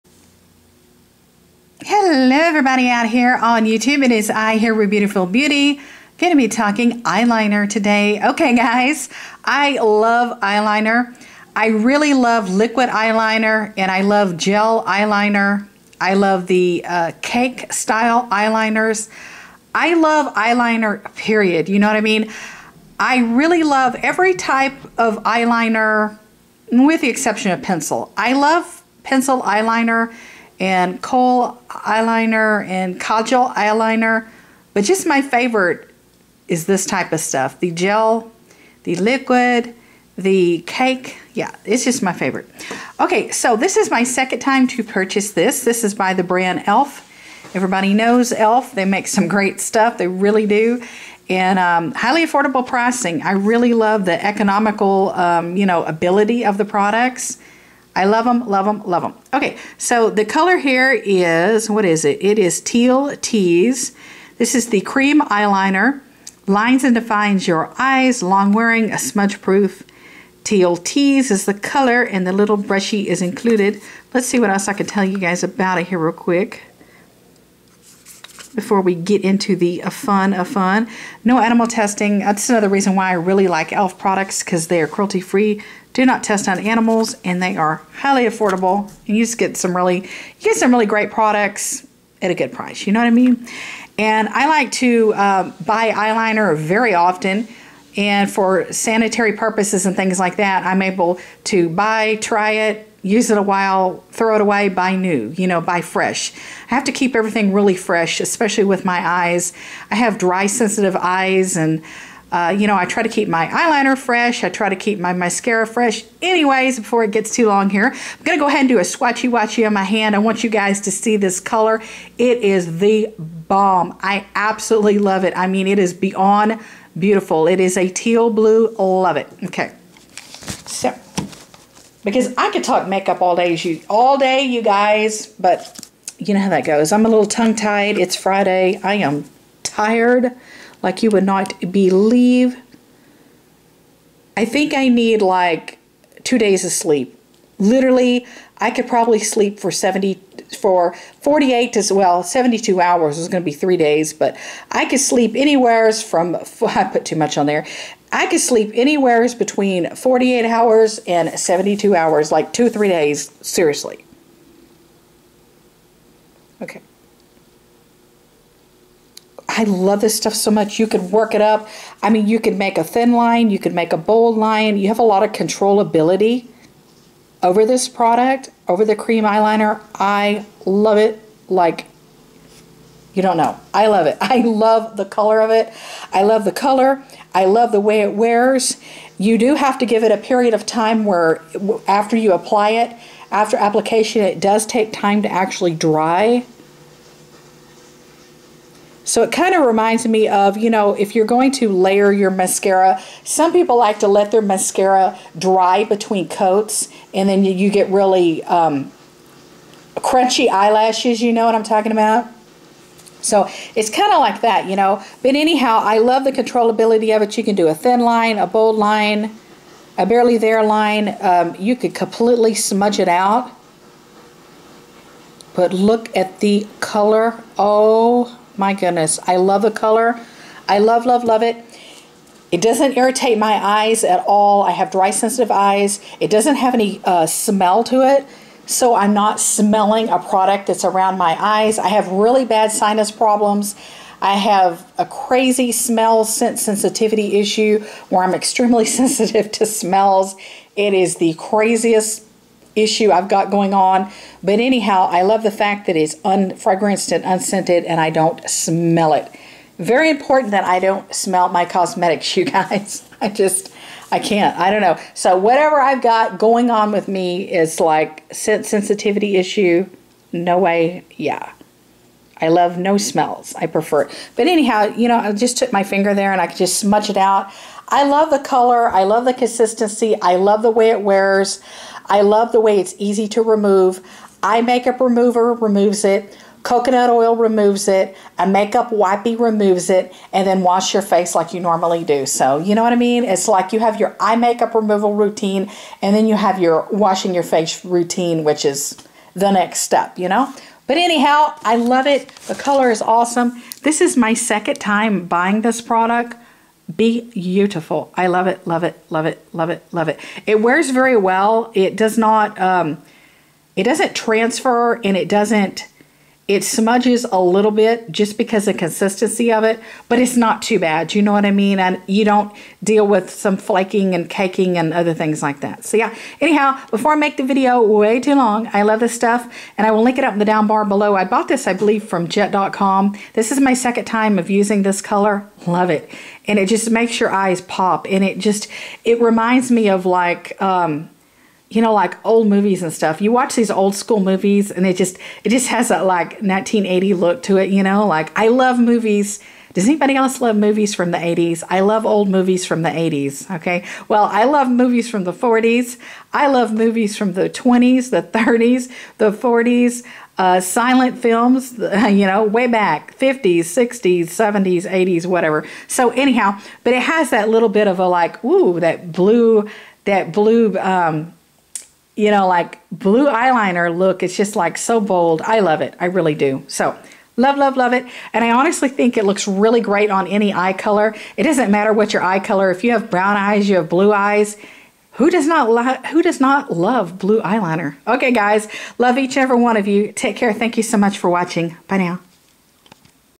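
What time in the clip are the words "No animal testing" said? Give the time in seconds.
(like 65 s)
81 s.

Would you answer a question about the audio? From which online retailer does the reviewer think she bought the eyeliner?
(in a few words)
jet.com.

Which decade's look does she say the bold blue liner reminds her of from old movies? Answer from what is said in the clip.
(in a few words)
1980s.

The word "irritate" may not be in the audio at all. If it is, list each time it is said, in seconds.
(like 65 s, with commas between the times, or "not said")
232 s.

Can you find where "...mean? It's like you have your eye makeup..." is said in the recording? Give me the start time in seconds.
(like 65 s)
292 s.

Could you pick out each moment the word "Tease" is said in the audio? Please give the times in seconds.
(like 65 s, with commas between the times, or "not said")
63 s, 70 s.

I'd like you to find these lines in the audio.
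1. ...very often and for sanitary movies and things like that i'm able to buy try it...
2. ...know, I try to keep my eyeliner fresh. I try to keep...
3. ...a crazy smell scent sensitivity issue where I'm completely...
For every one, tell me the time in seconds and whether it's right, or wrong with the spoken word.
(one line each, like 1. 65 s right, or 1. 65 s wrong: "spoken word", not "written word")
1. 96 s wrong: "purposes", not "movies"
2. 112 s right
3. 244 s wrong: "extremely", not "completely".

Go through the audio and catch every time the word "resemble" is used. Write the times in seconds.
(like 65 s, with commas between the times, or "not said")
not said.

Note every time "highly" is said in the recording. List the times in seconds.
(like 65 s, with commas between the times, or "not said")
51 s, 87 s.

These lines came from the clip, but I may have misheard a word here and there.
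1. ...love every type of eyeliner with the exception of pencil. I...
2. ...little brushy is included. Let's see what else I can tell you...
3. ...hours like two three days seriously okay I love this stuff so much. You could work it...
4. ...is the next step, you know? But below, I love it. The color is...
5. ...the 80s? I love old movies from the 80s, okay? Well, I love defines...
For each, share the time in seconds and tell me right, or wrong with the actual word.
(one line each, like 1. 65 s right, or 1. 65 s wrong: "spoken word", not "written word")
1. 23 s right
2. 72 s right
3. 161 s right
4. 298 s wrong: "anyhow", not "below"
5. 351 s wrong: "movies", not "defines".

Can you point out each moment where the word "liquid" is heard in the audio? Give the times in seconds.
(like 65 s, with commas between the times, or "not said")
12 s, 38 s.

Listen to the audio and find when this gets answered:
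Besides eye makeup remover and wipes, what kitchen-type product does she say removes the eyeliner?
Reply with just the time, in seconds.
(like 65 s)
286 s.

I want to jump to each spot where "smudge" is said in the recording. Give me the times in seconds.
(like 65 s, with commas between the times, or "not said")
68 s, 222 s, 276 s, 316 s.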